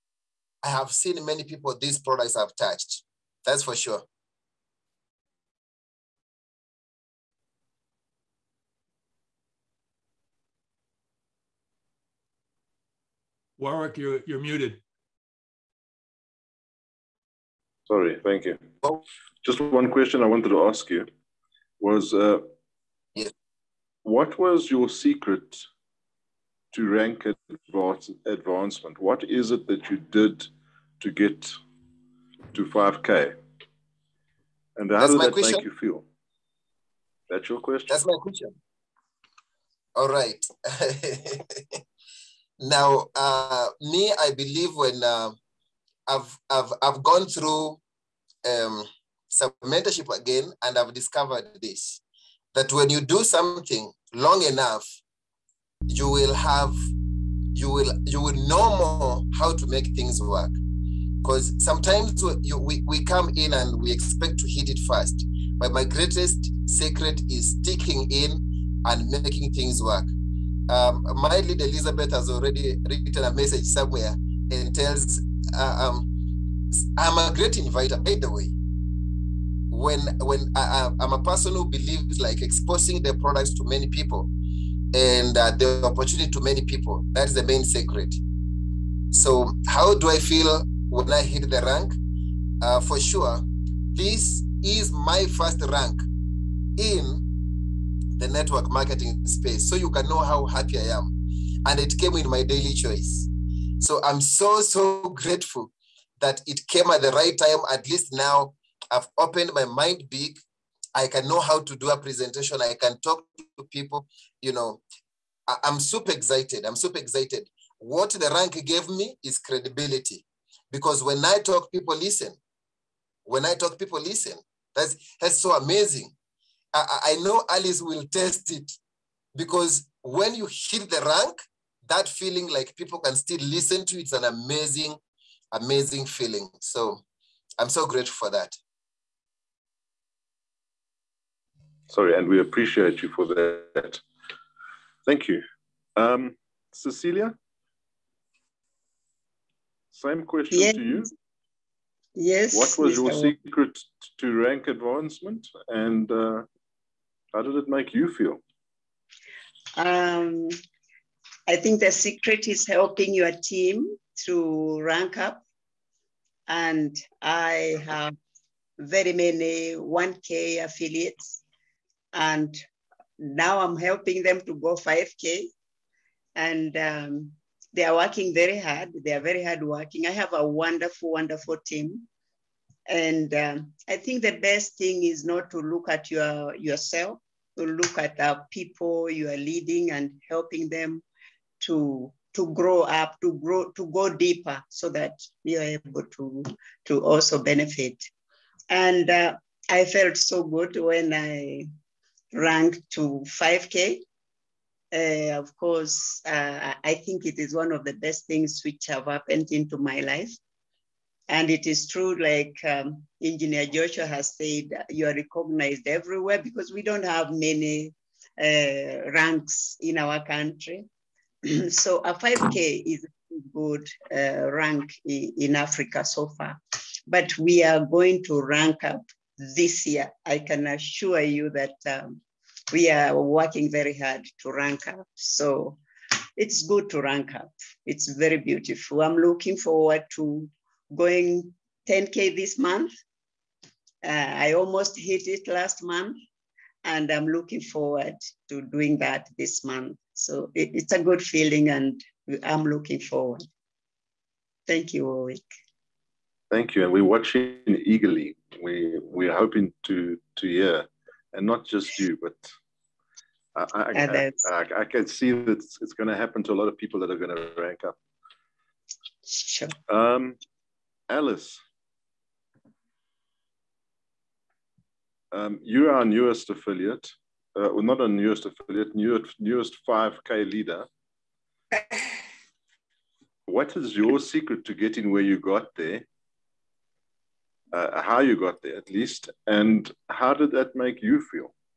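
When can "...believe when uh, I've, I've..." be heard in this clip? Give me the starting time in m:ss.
0:44.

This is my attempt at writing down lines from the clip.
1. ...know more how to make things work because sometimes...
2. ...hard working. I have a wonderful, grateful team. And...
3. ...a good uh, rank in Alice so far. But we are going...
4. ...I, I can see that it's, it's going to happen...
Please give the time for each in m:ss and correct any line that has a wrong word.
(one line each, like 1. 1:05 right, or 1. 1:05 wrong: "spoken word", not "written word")
1. 0:58 right
2. 2:59 wrong: "wonderful", not "grateful"
3. 3:43 wrong: "Africa", not "Alice"
4. 4:24 right.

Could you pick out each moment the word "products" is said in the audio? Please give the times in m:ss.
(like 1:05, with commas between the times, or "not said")
0:01, 1:23.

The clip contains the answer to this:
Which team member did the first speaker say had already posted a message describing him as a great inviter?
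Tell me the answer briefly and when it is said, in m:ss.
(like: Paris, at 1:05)
Elizabeth, at 1:11.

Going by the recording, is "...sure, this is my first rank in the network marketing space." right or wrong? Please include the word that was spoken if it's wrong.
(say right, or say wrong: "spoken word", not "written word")
right.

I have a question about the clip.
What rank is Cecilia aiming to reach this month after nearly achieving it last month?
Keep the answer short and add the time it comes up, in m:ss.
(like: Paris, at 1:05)
10K, at 4:01.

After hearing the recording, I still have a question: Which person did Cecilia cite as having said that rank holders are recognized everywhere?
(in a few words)
Engineer Joshua.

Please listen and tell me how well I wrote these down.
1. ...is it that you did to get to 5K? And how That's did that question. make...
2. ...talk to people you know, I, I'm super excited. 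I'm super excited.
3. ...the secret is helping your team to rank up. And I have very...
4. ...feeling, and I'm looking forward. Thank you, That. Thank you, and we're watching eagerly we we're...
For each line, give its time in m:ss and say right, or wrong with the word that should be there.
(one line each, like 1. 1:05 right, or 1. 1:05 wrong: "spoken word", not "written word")
1. 0:29 right
2. 1:52 right
3. 2:41 right
4. 4:11 wrong: "Warwick", not "That".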